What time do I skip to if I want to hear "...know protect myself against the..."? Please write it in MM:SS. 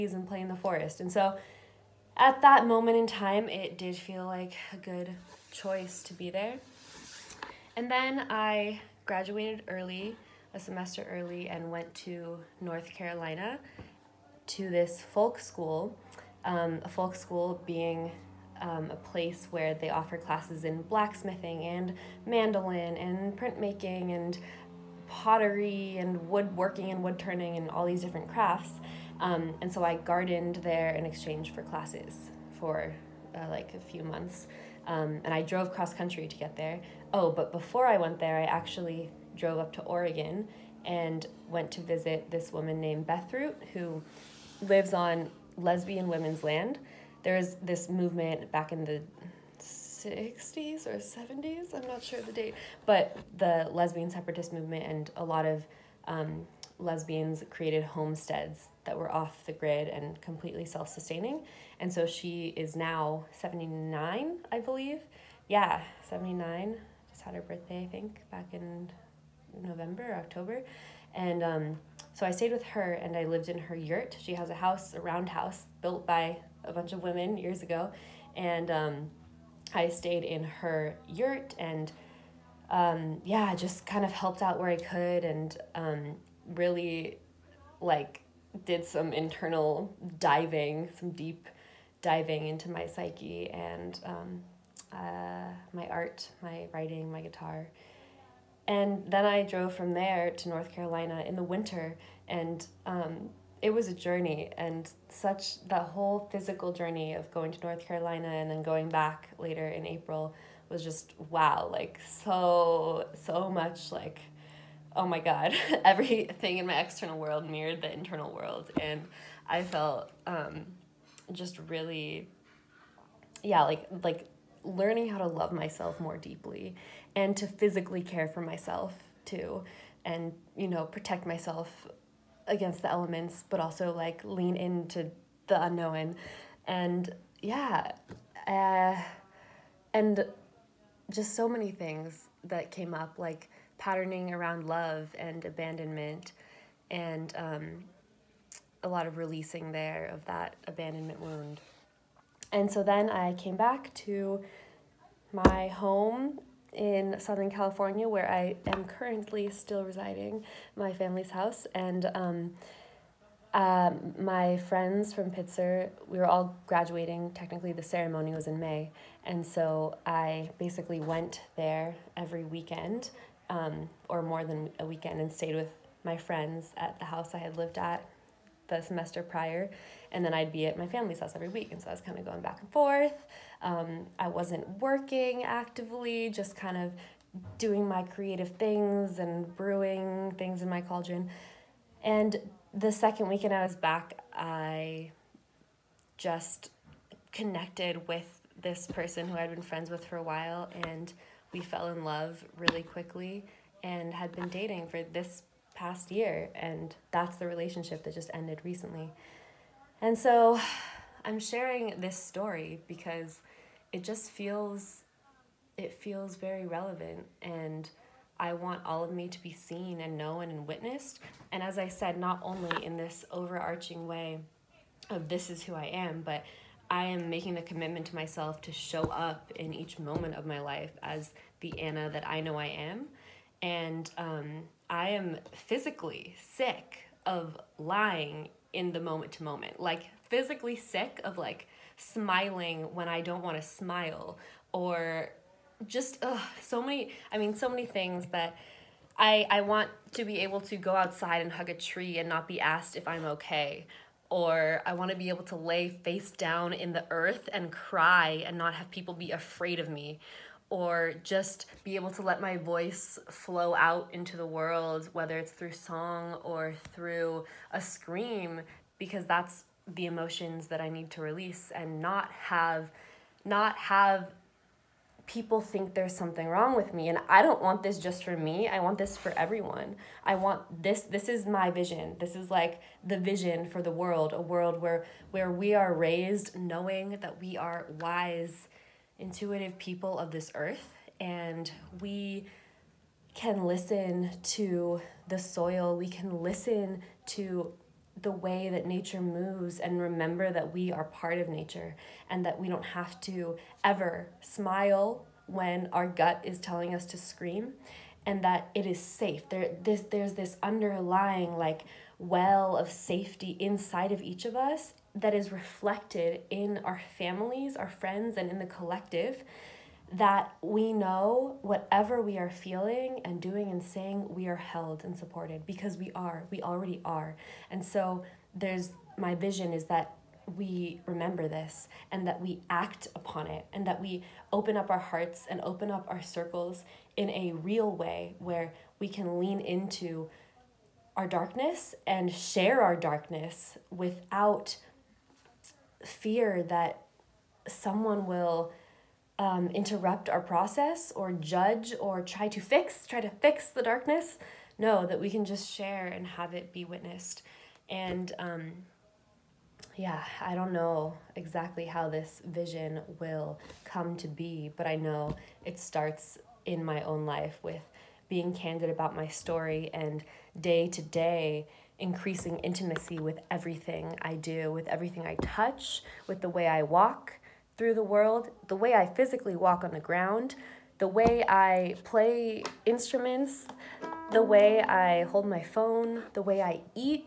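02:10.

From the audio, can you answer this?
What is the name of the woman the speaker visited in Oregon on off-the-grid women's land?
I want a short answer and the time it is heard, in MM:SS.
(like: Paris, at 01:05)
Bethroot, at 00:43.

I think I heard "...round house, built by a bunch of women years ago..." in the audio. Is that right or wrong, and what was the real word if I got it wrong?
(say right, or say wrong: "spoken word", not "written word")
right.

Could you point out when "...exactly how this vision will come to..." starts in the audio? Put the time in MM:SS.
06:01.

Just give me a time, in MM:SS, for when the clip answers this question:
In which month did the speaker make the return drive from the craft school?
01:49.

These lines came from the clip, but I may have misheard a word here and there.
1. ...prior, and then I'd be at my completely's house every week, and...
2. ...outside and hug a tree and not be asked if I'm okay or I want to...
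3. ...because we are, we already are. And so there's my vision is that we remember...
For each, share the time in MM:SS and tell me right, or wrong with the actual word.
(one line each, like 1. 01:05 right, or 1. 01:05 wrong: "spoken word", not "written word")
1. 02:59 wrong: "family", not "completely"
2. 04:10 right
3. 05:25 right.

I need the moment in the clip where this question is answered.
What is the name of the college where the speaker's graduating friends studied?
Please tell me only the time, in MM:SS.
02:45.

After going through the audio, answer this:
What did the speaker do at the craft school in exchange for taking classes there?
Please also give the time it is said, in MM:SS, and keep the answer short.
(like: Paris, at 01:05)
Gardened, at 00:29.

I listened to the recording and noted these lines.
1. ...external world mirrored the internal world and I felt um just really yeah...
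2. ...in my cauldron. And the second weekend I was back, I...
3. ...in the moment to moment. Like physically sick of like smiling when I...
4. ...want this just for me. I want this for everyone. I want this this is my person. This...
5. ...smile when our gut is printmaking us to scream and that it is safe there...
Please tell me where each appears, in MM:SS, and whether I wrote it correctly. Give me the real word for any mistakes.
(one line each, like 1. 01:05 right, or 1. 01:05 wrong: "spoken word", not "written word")
1. 01:56 right
2. 03:10 right
3. 03:58 right
4. 04:37 wrong: "vision", not "person"
5. 05:04 wrong: "telling", not "printmaking".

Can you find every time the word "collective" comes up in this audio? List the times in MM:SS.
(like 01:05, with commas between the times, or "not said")
05:18.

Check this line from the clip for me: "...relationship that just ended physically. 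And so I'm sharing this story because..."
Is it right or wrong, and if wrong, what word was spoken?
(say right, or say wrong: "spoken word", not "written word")
wrong: "recently", not "physically".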